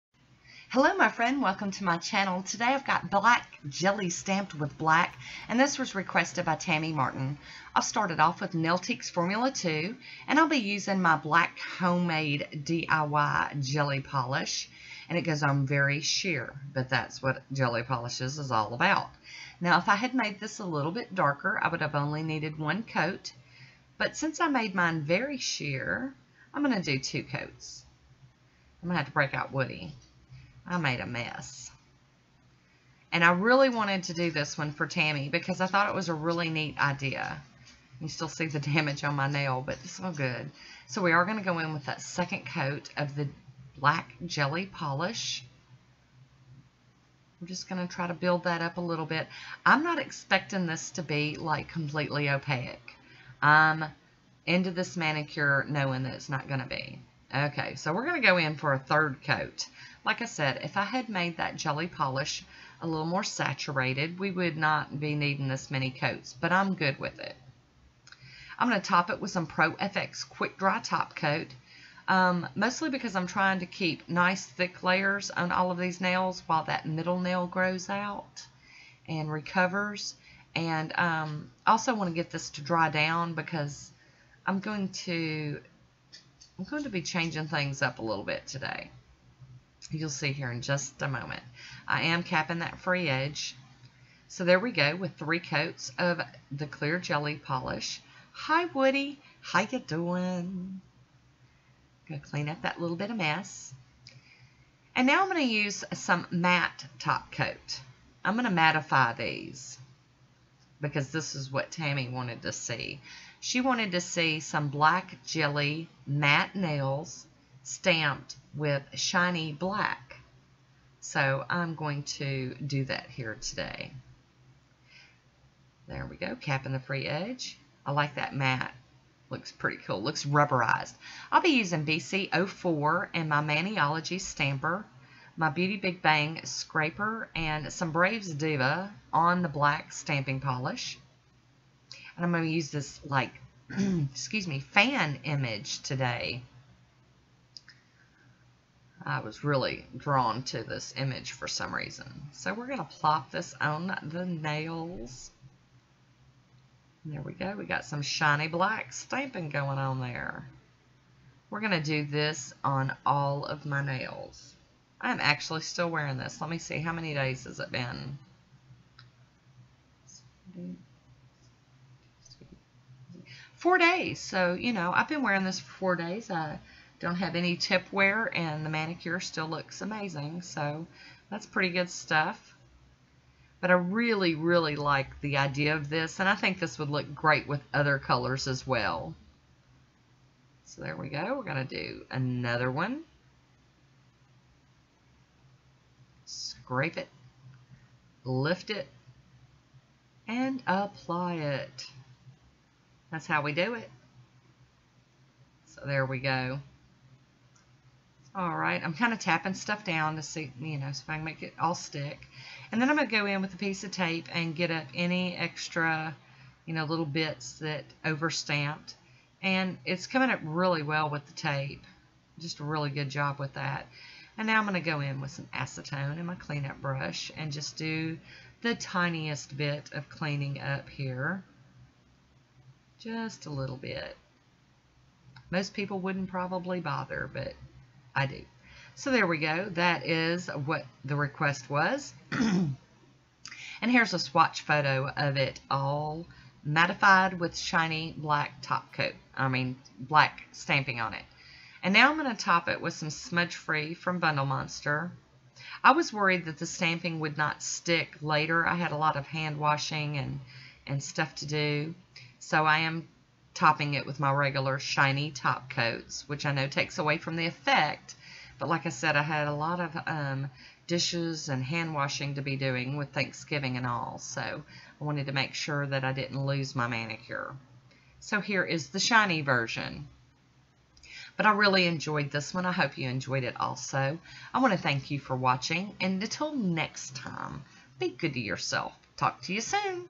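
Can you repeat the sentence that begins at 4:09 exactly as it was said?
I mean, black stamping on it.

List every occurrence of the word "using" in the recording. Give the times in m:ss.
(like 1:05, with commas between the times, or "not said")
0:10, 2:11.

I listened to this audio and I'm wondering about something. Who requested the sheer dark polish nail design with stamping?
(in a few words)
Tammy Martin.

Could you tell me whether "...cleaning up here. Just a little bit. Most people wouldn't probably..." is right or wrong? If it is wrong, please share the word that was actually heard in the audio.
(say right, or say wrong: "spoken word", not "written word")
right.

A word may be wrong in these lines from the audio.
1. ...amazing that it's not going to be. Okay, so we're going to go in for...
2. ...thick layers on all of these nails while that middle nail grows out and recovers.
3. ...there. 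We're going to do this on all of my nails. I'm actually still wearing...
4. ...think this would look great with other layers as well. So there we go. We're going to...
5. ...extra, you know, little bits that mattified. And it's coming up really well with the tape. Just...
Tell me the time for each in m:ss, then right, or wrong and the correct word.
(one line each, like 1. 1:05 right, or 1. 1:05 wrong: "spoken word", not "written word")
1. 0:55 wrong: "knowing", not "amazing"
2. 1:14 right
3. 2:40 right
4. 3:06 wrong: "colors", not "layers"
5. 3:35 wrong: "overstamped", not "mattified".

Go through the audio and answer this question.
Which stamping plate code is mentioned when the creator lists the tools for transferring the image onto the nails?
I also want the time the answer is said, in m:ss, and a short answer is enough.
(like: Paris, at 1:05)
BC04, at 2:11.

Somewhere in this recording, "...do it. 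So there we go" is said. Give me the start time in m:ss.
3:23.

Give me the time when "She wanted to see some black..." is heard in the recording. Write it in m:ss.
1:53.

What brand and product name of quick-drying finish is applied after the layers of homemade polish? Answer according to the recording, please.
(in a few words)
Pro FX Quick Dry Top Coat.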